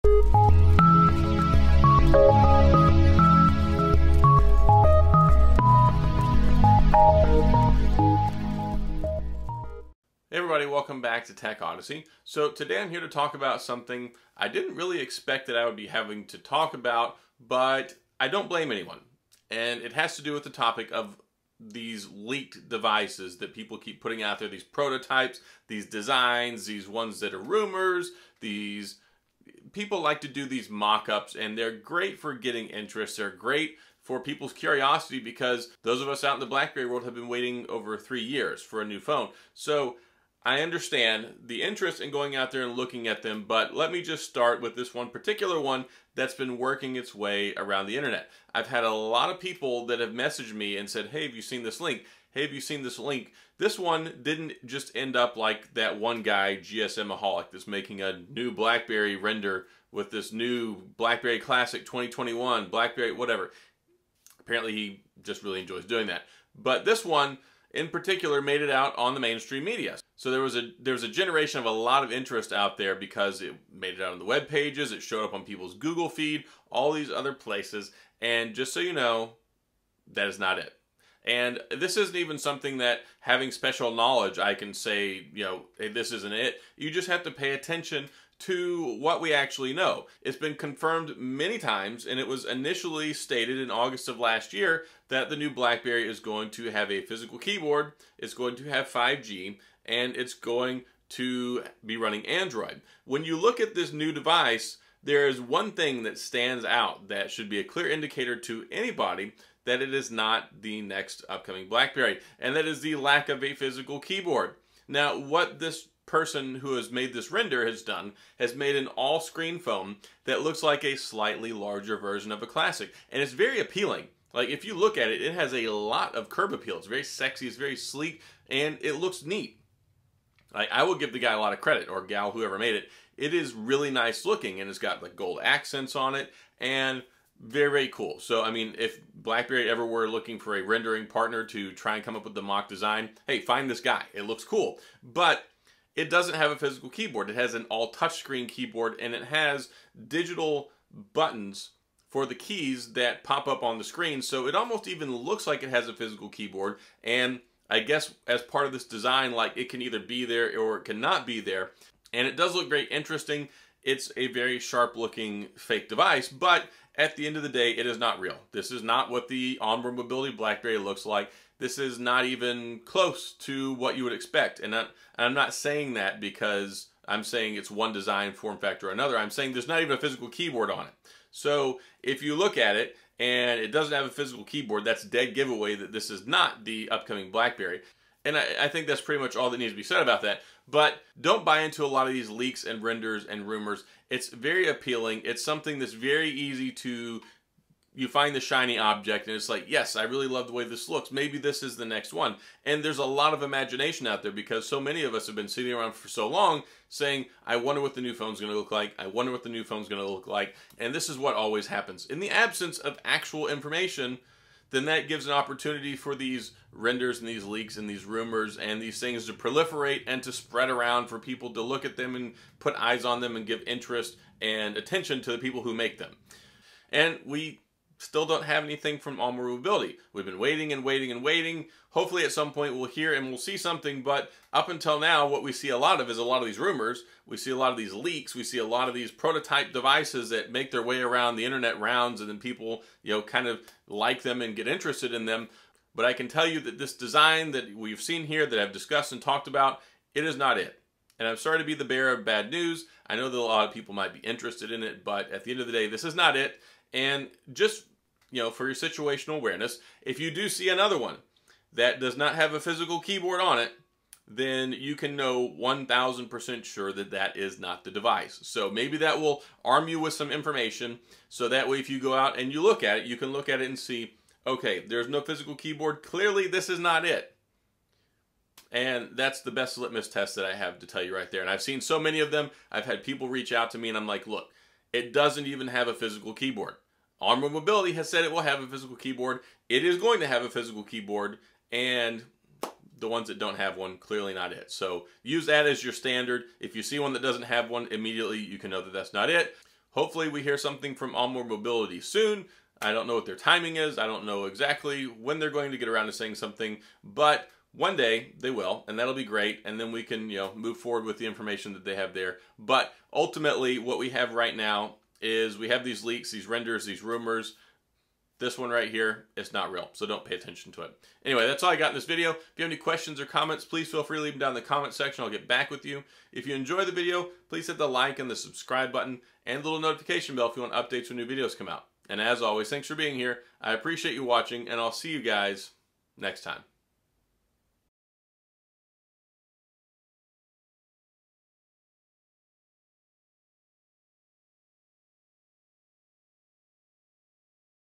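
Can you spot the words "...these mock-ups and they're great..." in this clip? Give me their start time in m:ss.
0:30.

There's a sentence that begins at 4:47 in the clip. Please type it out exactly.
OnwardMobility has said it will have a physical keyboard.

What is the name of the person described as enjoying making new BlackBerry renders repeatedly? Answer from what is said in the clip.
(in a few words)
GSMaholic.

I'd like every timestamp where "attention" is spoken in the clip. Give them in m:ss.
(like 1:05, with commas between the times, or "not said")
1:27, 3:44, 5:20.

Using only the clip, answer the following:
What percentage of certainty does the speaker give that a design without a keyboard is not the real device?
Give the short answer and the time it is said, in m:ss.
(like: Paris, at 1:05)
1000%, at 4:25.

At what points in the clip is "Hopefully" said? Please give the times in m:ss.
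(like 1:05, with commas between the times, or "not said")
3:51, 4:59.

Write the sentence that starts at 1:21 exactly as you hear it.
And this isn't even something that having special knowledge, I can say, you know, hey, this isn't it.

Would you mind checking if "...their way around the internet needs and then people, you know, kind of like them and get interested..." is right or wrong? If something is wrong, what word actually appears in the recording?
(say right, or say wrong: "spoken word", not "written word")
wrong: "rounds", not "needs".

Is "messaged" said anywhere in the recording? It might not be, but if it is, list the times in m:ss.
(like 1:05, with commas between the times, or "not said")
0:50.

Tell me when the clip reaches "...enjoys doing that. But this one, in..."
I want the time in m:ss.
1:05.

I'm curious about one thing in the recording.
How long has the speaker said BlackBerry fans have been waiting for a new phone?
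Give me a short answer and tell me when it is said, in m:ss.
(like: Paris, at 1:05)
over three years, at 0:37.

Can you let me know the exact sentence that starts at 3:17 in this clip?
You find the shiny object, and it's like, yes, I really love the way this looks.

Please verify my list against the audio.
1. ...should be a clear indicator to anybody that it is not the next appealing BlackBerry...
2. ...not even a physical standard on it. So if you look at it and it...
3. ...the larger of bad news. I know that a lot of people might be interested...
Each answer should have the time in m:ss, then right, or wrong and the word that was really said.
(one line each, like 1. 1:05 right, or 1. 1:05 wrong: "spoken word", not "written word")
1. 1:47 wrong: "upcoming", not "appealing"
2. 2:59 wrong: "keyboard", not "standard"
3. 4:11 wrong: "bearer", not "larger".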